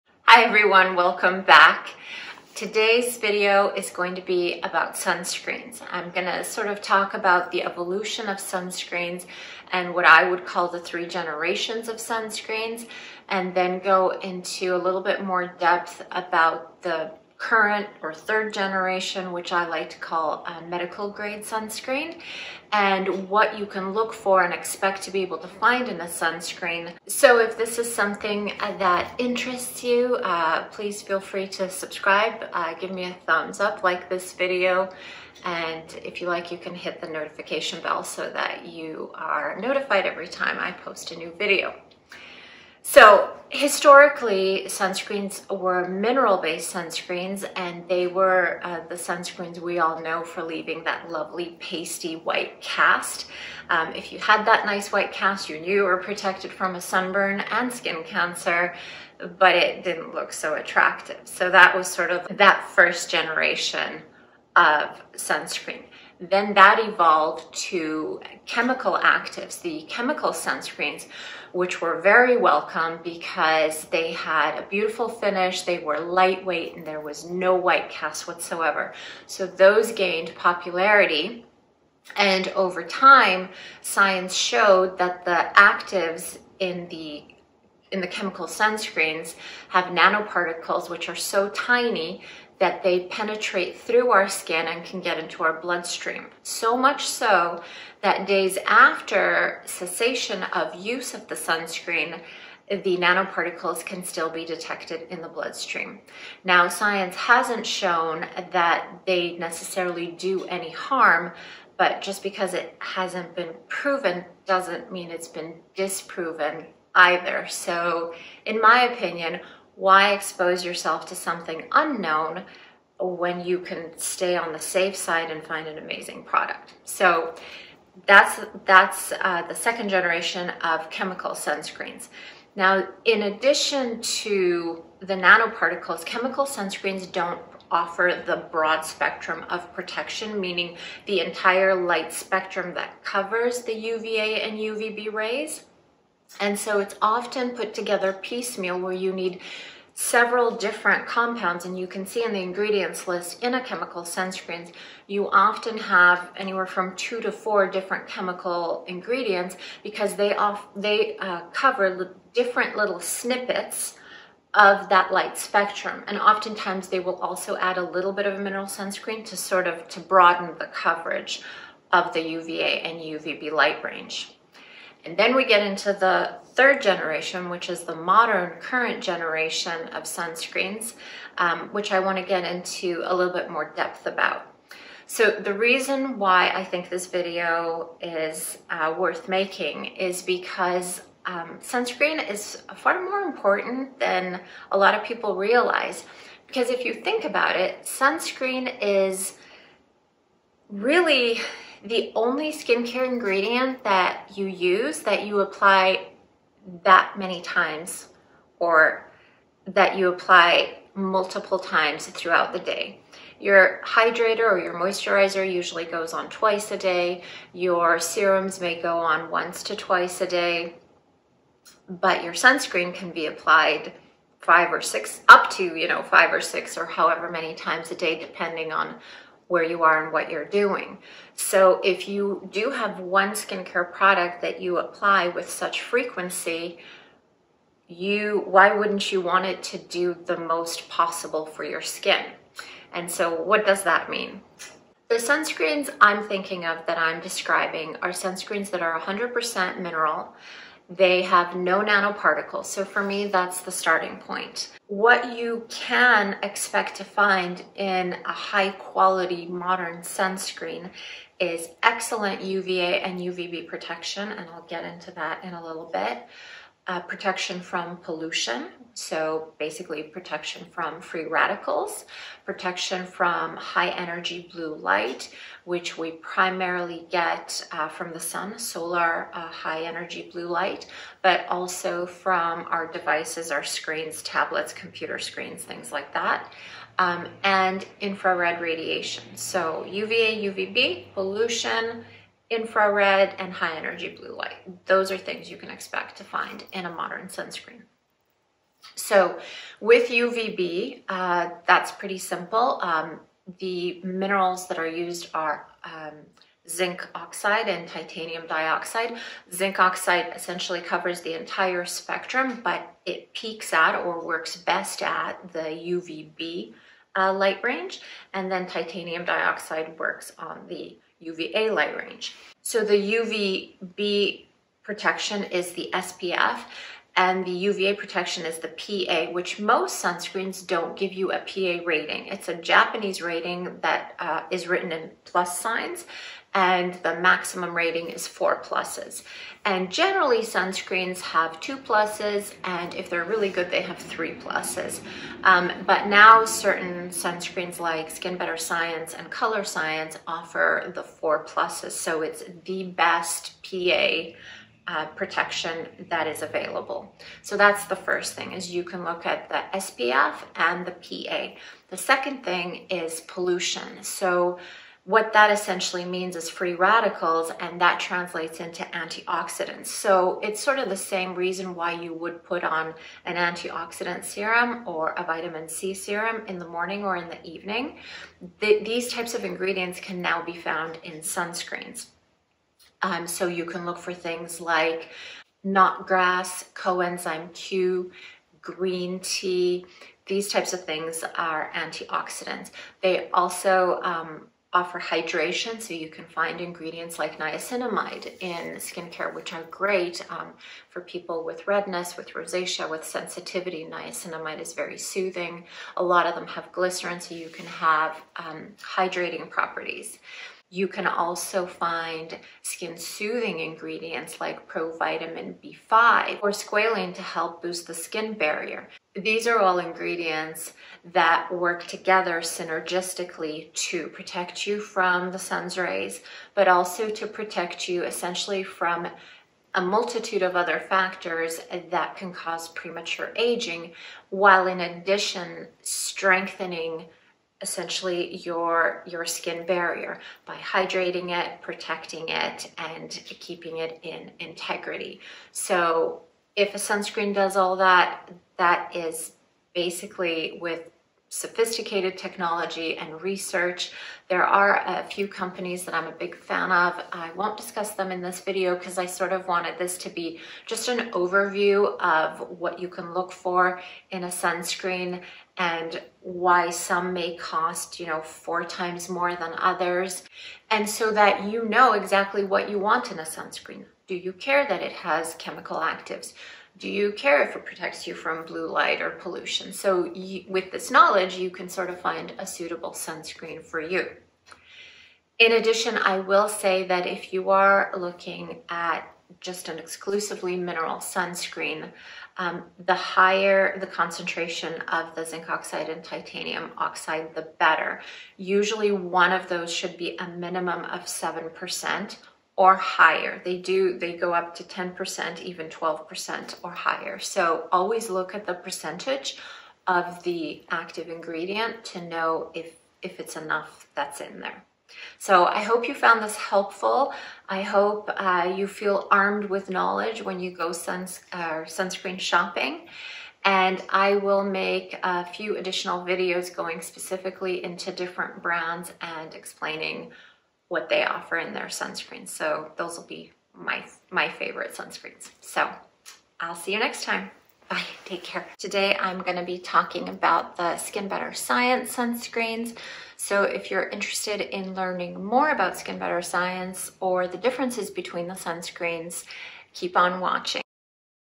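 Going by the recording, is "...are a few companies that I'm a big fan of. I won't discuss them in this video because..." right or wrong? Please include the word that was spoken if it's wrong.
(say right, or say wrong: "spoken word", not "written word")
right.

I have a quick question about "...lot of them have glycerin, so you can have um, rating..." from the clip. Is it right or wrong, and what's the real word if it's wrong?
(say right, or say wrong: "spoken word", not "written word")
wrong: "hydrating", not "rating".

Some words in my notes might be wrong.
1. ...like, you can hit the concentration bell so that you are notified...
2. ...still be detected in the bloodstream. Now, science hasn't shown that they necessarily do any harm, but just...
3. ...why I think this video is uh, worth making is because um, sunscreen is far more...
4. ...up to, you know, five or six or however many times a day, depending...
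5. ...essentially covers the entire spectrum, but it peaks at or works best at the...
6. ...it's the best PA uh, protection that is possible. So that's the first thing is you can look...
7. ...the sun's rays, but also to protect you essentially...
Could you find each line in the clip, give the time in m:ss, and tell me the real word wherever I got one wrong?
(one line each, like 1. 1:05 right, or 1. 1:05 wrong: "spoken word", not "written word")
1. 0:36 wrong: "notification", not "concentration"
2. 1:44 right
3. 3:06 right
4. 3:45 right
5. 5:10 right
6. 5:52 wrong: "available", not "possible"
7. 7:05 right.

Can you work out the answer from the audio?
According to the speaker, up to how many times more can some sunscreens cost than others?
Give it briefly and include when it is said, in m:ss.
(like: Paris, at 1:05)
4 times, at 7:48.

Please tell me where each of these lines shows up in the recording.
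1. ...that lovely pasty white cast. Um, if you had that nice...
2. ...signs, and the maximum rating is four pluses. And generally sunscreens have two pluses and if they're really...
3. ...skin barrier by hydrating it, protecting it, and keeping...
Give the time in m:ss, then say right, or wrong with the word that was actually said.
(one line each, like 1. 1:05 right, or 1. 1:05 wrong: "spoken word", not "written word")
1. 0:50 right
2. 5:35 right
3. 7:19 right.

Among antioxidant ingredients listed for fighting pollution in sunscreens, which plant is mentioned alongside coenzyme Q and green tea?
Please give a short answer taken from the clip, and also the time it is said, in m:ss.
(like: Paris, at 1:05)
Knotgrass, at 6:25.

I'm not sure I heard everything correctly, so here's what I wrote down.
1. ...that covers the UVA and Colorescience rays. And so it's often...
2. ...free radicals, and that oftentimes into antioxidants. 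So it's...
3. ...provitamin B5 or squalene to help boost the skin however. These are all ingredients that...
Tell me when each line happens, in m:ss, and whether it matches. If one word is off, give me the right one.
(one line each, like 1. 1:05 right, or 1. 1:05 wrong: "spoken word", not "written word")
1. 2:22 wrong: "UVB", not "Colorescience"
2. 6:06 wrong: "translates", not "oftentimes"
3. 6:54 wrong: "barrier", not "however".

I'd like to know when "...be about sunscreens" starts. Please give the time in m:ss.
0:04.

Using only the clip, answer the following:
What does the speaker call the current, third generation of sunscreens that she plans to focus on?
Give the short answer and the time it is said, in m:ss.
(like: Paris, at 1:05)
Medical grade sunscreen, at 0:20.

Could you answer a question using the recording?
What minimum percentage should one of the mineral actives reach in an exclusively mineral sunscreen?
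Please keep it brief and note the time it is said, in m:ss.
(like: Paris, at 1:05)
7%, at 8:21.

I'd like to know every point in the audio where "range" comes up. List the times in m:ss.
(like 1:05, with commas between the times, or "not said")
2:53, 5:17, 5:21.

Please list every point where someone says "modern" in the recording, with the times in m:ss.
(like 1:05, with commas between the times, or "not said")
2:57, 4:19, 4:56.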